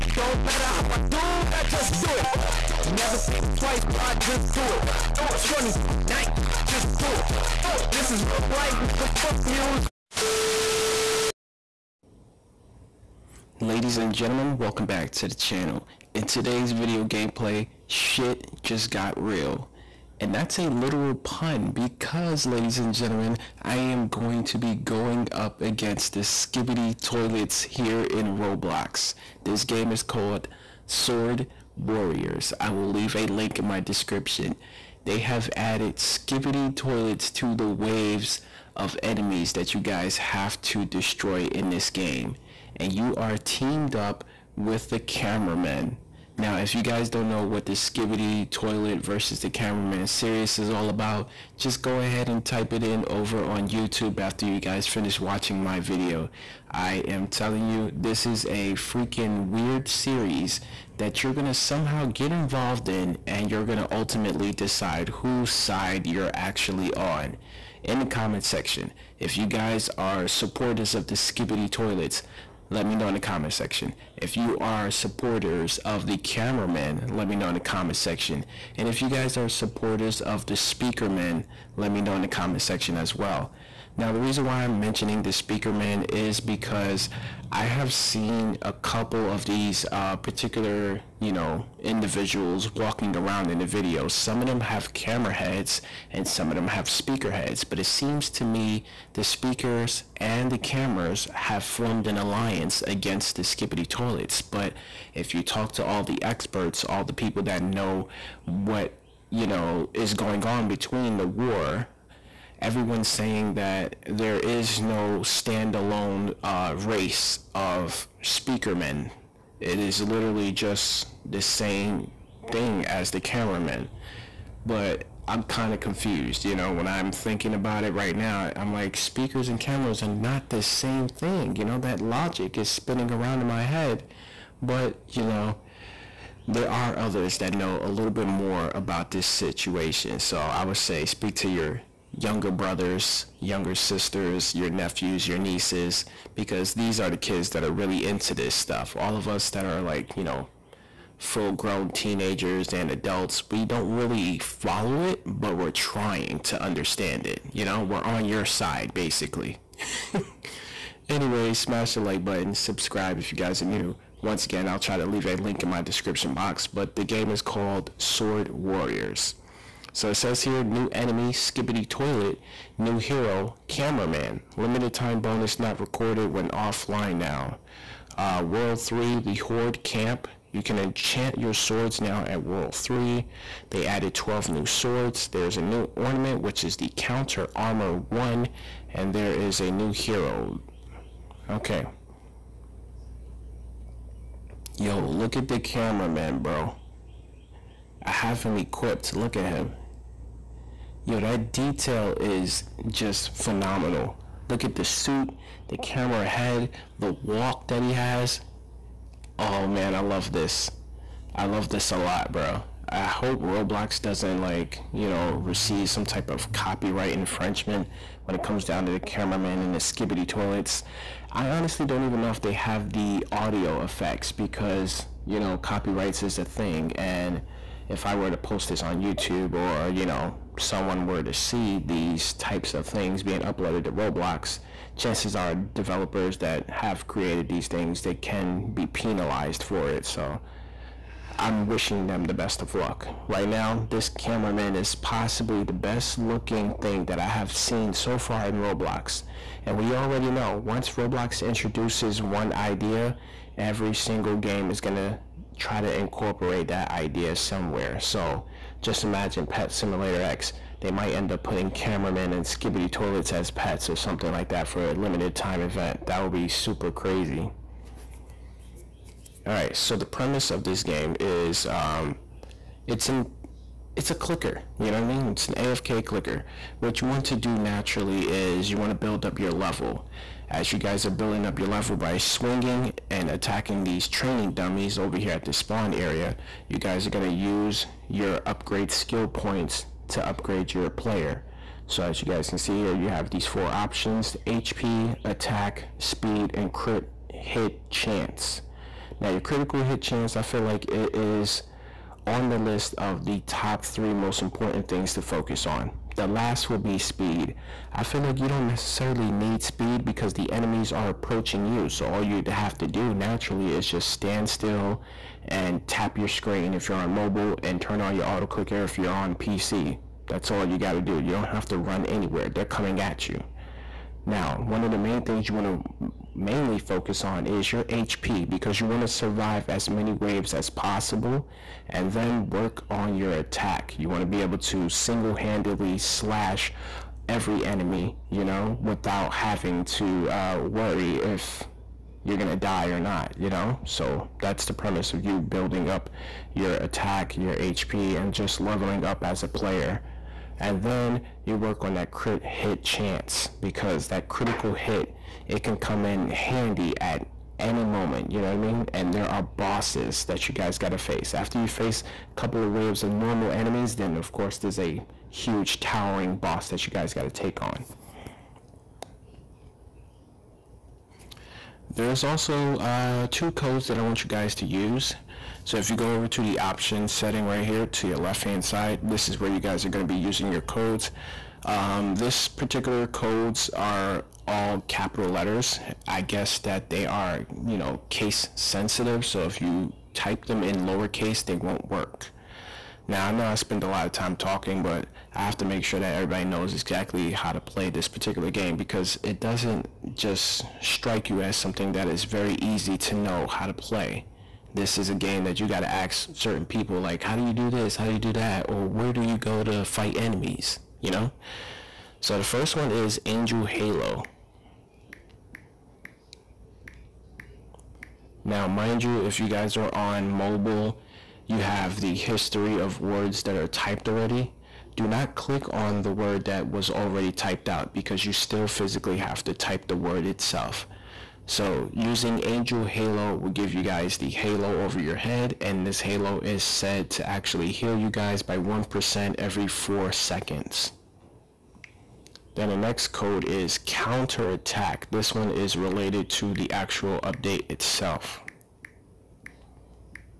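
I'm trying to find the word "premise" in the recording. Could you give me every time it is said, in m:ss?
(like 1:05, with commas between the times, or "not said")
4:30, 5:44.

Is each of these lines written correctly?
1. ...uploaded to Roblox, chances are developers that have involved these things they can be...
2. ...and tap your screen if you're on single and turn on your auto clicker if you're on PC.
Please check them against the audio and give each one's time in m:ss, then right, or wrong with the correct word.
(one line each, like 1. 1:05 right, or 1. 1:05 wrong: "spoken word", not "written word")
1. 3:53 wrong: "created", not "involved"
2. 5:15 wrong: "mobile", not "single".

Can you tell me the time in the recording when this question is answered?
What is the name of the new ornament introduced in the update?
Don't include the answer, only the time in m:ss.
3:06.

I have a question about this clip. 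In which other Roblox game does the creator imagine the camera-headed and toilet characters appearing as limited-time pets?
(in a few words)
Pet Simulator X.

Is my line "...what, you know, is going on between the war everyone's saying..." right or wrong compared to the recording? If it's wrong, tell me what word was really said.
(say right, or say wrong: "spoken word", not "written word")
right.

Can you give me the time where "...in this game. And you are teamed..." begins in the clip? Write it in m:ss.
0:41.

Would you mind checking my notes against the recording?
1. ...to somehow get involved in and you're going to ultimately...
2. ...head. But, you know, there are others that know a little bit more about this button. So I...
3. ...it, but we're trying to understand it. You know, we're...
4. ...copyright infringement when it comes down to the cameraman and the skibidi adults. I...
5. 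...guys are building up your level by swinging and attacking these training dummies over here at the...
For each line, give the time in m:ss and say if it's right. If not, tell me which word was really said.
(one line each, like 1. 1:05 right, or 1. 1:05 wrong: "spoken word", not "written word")
1. 1:01 right
2. 2:13 wrong: "situation", not "button"
3. 2:35 right
4. 3:36 wrong: "toilets", not "adults"
5. 4:40 right.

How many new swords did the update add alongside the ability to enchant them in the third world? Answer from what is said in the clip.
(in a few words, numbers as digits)
12.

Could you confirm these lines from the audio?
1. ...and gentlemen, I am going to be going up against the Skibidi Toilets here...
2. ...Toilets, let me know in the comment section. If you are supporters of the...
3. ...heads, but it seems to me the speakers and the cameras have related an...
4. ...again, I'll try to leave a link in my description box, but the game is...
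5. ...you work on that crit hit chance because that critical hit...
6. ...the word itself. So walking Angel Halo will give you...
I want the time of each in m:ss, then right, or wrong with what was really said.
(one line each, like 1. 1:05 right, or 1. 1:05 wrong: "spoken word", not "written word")
1. 0:22 right
2. 1:11 right
3. 1:37 wrong: "formed", not "related"
4. 2:44 right
5. 5:51 right
6. 7:09 wrong: "using", not "walking".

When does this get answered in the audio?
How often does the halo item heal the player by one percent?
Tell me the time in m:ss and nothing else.
7:19.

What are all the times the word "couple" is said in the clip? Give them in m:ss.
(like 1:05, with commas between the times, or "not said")
1:28, 6:02.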